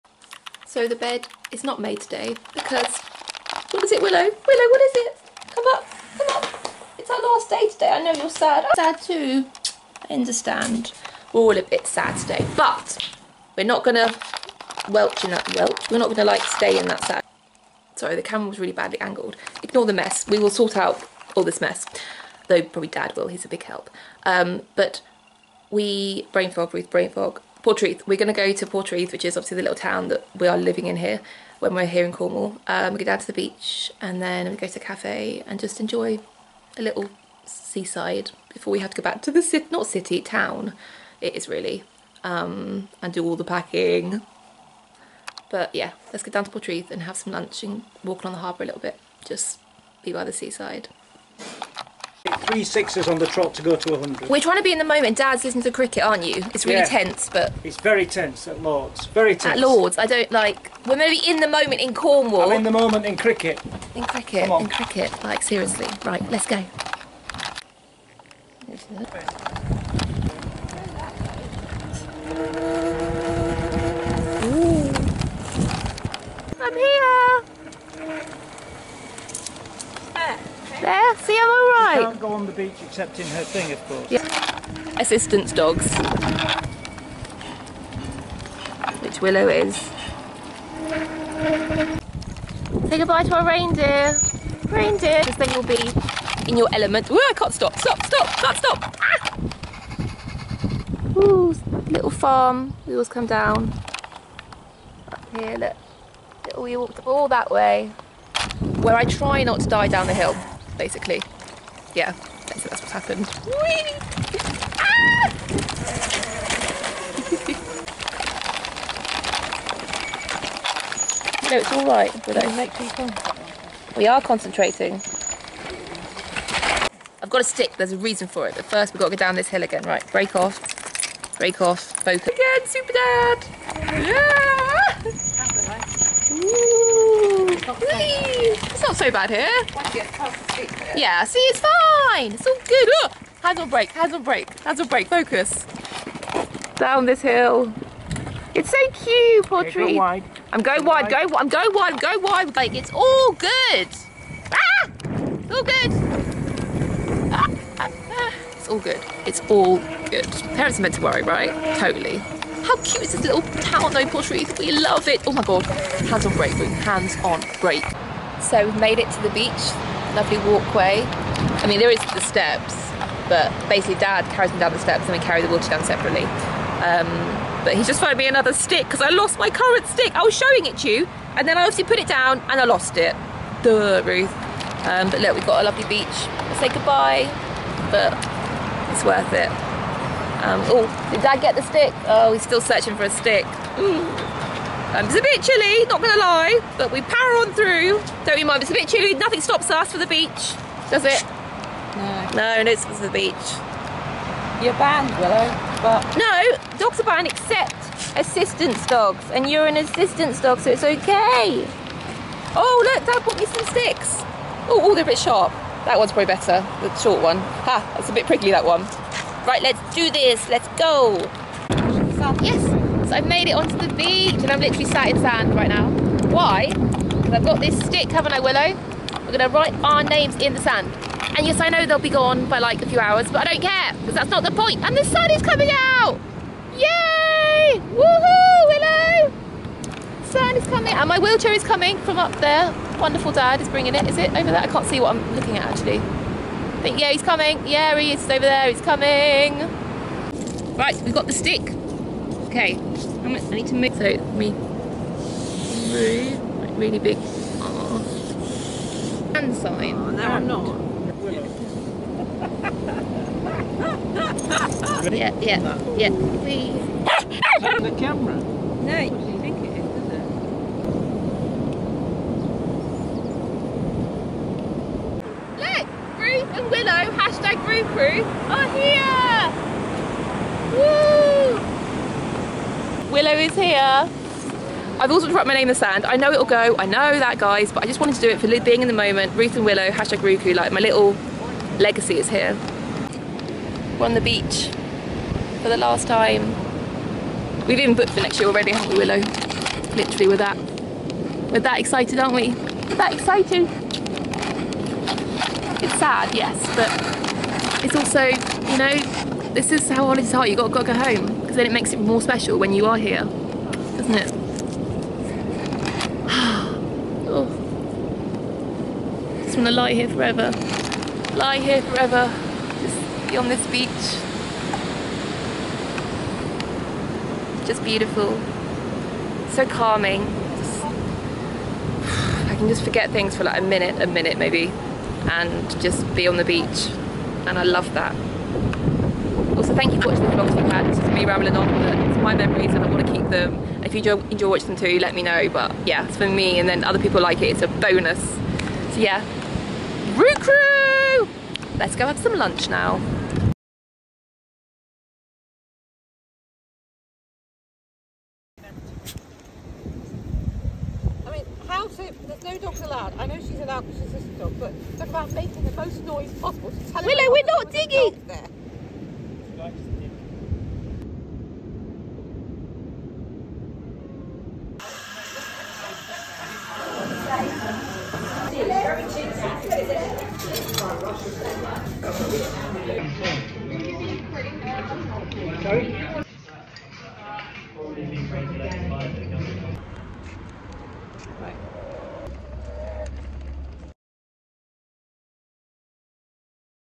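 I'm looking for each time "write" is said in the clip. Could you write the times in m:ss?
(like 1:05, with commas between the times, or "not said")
3:49.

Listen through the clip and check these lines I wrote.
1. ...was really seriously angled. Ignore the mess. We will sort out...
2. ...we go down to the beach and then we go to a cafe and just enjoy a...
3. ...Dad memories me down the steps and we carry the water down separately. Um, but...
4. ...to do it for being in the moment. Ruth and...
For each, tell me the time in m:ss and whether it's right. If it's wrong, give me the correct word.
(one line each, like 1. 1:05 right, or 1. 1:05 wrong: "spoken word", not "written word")
1. 0:18 wrong: "badly", not "seriously"
2. 0:32 right
3. 2:53 wrong: "carries", not "memories"
4. 4:48 right.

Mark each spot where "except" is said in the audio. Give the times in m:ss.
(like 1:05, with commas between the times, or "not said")
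1:22, 3:27.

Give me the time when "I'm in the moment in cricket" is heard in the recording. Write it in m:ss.
1:02.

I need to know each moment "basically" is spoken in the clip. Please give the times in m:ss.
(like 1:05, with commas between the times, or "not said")
1:50, 2:53.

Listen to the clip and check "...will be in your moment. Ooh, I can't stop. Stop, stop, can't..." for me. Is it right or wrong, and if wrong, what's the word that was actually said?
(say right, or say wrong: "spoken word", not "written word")
wrong: "element", not "moment".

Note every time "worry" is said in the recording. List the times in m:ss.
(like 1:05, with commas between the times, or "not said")
2:41.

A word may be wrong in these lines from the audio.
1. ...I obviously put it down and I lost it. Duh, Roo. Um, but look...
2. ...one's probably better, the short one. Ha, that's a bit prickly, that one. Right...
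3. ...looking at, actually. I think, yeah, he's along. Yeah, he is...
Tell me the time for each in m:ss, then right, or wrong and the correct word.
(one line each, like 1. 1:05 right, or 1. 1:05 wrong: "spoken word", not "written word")
1. 3:01 wrong: "Ruth", not "Roo"
2. 3:35 right
3. 4:05 wrong: "coming", not "along".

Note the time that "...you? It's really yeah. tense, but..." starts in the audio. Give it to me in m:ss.
0:56.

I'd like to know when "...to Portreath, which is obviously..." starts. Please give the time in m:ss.
0:28.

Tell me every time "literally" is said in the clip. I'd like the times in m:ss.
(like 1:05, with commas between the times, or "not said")
3:44, 4:59.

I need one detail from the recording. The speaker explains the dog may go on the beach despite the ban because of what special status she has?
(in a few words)
Assistance dog.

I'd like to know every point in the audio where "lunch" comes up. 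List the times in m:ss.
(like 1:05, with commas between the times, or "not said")
0:47, 5:52.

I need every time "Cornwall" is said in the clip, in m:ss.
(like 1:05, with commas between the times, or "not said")
0:32, 1:01.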